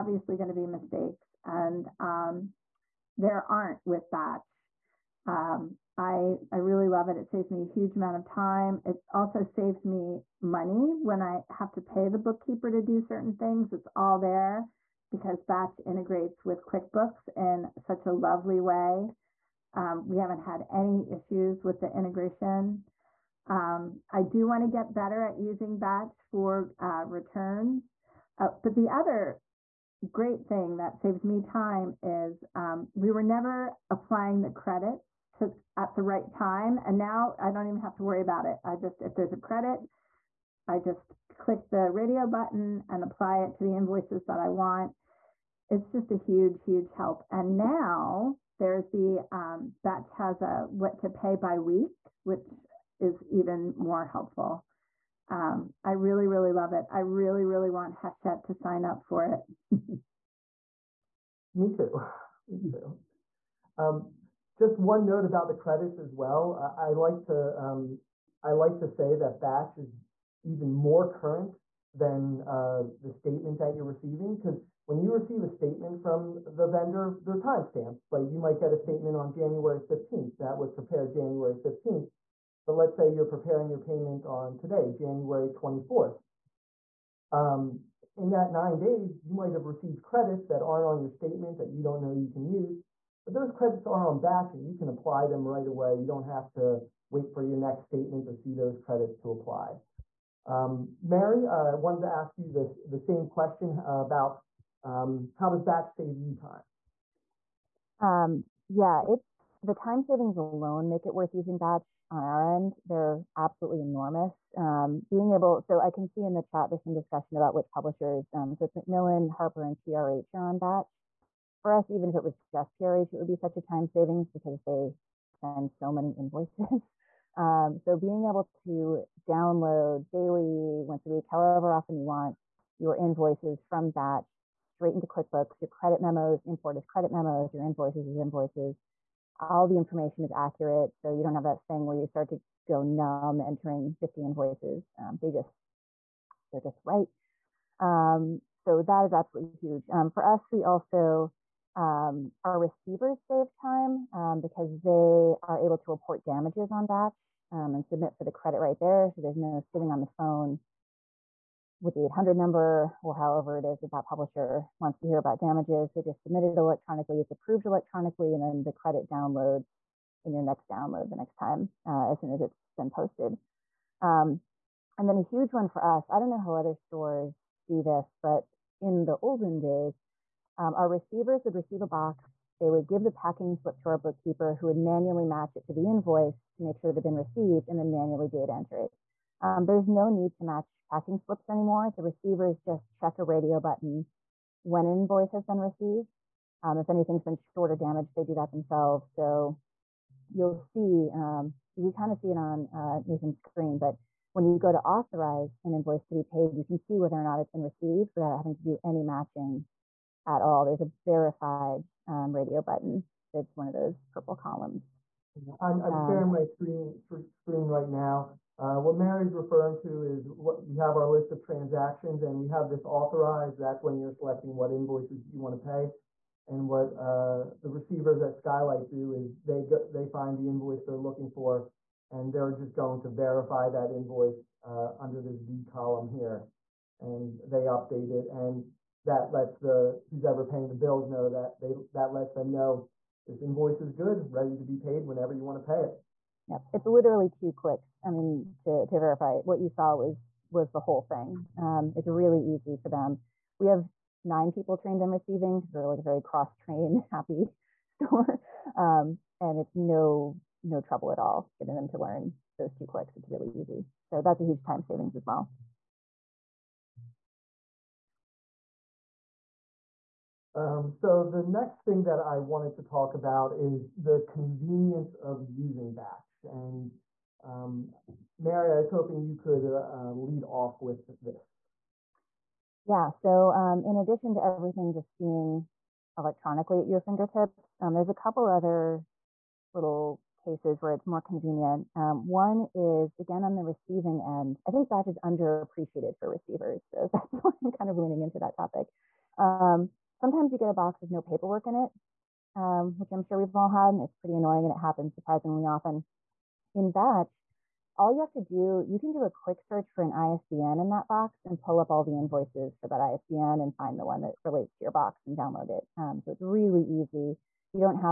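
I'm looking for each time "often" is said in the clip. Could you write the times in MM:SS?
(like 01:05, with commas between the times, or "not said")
02:11, 05:05.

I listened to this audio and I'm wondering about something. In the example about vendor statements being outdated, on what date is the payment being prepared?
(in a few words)
January 24th.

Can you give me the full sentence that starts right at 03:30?
There's a verified um, radio button that's one of those purple columns.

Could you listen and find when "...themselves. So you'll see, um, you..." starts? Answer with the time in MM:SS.
03:18.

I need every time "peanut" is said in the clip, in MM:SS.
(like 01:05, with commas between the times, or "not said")
not said.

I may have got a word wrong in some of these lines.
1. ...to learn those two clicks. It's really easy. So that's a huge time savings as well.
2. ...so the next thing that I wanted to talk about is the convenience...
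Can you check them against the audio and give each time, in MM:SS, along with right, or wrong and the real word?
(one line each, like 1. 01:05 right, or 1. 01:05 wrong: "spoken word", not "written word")
1. 04:21 right
2. 04:30 right.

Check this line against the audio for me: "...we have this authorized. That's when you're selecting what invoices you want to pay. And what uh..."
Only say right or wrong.
right.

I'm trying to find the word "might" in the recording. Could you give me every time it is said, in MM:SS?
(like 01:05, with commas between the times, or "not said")
01:18, 01:29.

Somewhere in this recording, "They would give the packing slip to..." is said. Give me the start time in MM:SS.
03:02.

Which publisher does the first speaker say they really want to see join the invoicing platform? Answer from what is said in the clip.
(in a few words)
Hachette.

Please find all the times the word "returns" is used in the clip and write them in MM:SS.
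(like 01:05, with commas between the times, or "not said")
00:27.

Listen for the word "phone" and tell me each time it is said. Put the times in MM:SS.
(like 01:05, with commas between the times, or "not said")
02:40.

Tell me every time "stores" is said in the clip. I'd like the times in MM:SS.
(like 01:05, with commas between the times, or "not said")
02:56, 04:17.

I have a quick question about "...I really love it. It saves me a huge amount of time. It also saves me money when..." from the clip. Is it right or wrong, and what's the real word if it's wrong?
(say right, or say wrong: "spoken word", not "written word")
right.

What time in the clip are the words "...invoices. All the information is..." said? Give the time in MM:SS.
02:18.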